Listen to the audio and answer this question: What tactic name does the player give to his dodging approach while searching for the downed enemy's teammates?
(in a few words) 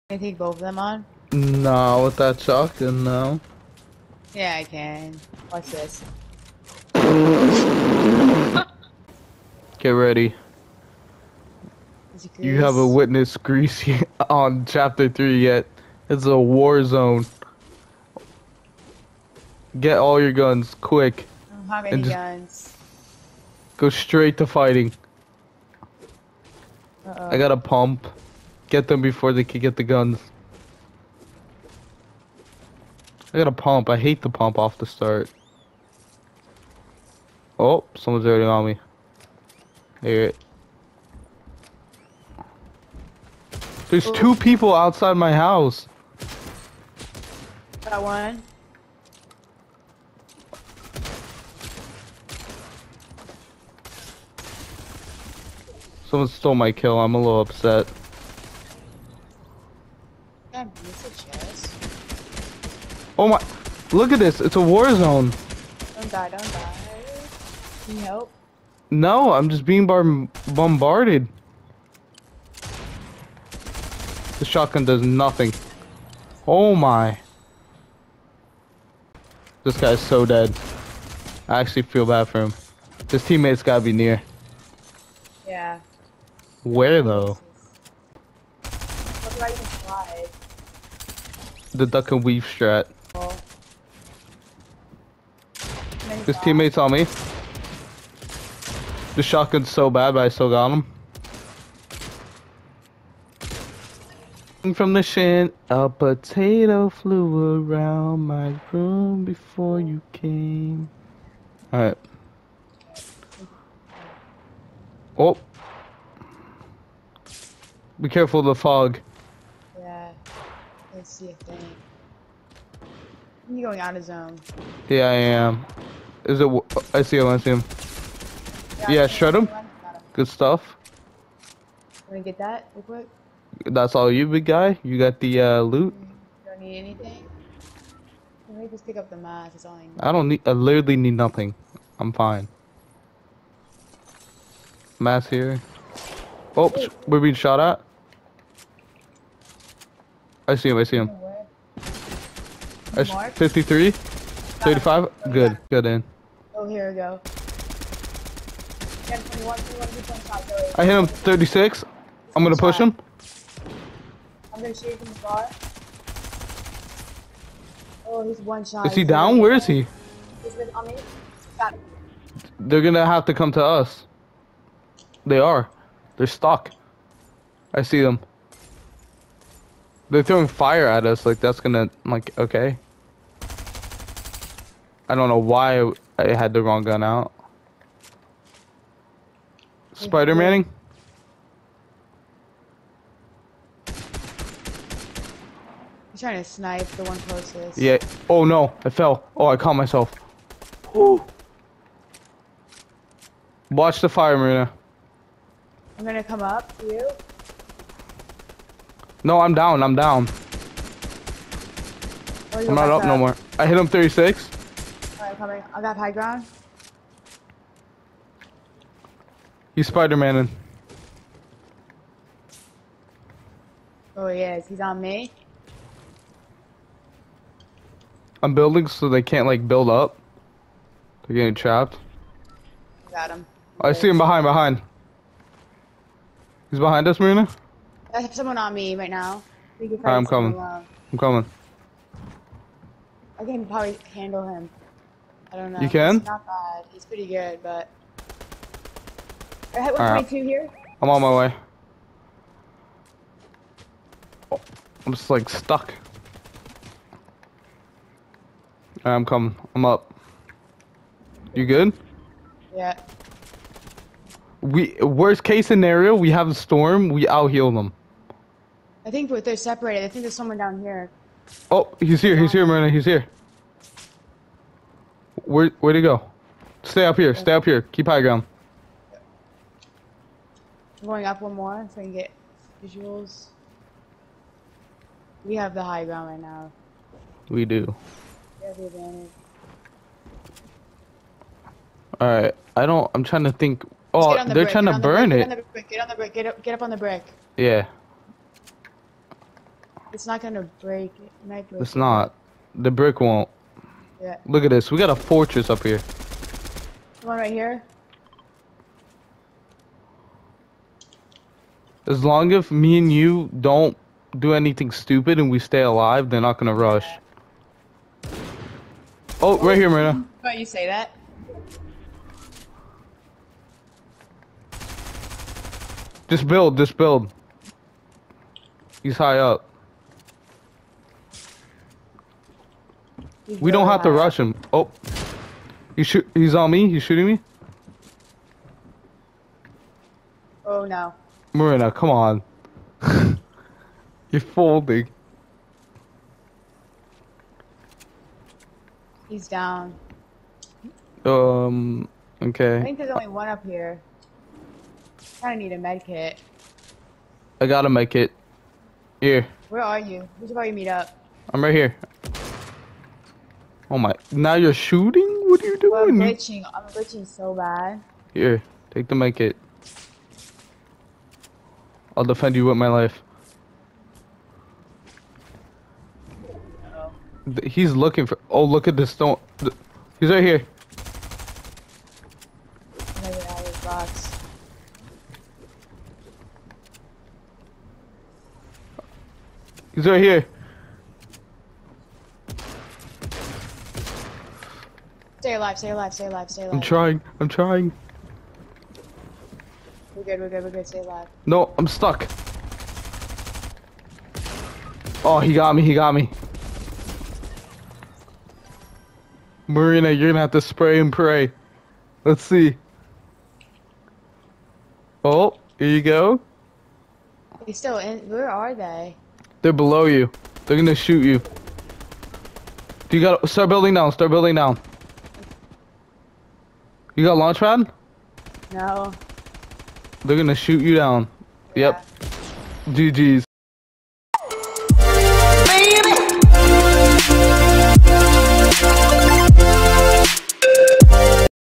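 duck and weave strat.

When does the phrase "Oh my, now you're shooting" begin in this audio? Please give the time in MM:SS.
06:03.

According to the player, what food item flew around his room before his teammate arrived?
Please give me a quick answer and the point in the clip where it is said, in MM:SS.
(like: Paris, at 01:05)
a potato, at 01:45.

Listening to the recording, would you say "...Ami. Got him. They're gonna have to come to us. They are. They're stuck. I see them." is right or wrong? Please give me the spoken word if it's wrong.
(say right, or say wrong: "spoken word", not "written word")
right.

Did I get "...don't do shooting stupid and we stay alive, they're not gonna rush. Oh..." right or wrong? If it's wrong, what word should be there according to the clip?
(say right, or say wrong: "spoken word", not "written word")
wrong: "anything", not "shooting".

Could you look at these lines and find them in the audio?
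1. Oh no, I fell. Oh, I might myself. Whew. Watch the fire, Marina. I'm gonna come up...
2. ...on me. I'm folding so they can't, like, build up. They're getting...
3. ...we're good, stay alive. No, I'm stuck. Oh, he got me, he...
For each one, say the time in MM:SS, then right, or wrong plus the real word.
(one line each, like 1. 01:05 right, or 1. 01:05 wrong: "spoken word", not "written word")
1. 03:18 wrong: "caught", not "might"
2. 03:44 wrong: "building", not "folding"
3. 06:40 right.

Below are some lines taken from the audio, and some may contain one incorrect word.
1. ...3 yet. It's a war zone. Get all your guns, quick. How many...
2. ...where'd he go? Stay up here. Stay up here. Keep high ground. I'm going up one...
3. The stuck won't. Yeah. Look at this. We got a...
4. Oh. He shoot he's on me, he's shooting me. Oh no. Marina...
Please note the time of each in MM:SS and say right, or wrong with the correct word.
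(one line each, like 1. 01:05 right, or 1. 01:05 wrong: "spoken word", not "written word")
1. 00:15 right
2. 04:35 right
3. 05:02 wrong: "brick", not "stuck"
4. 05:34 right.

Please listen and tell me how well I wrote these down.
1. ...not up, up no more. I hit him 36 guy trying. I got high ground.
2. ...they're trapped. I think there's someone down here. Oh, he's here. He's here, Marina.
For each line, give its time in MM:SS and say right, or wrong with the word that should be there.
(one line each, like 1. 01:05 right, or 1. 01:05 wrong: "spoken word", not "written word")
1. 03:32 wrong: "coming", not "trying"
2. 04:29 wrong: "separated", not "trapped".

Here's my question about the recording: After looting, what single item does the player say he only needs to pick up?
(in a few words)
the mask.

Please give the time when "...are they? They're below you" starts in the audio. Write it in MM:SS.
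06:58.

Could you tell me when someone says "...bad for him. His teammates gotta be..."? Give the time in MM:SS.
01:22.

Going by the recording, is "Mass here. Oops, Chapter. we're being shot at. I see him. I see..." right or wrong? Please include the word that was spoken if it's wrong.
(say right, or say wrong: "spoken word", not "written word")
wrong: "Wait", not "Chapter".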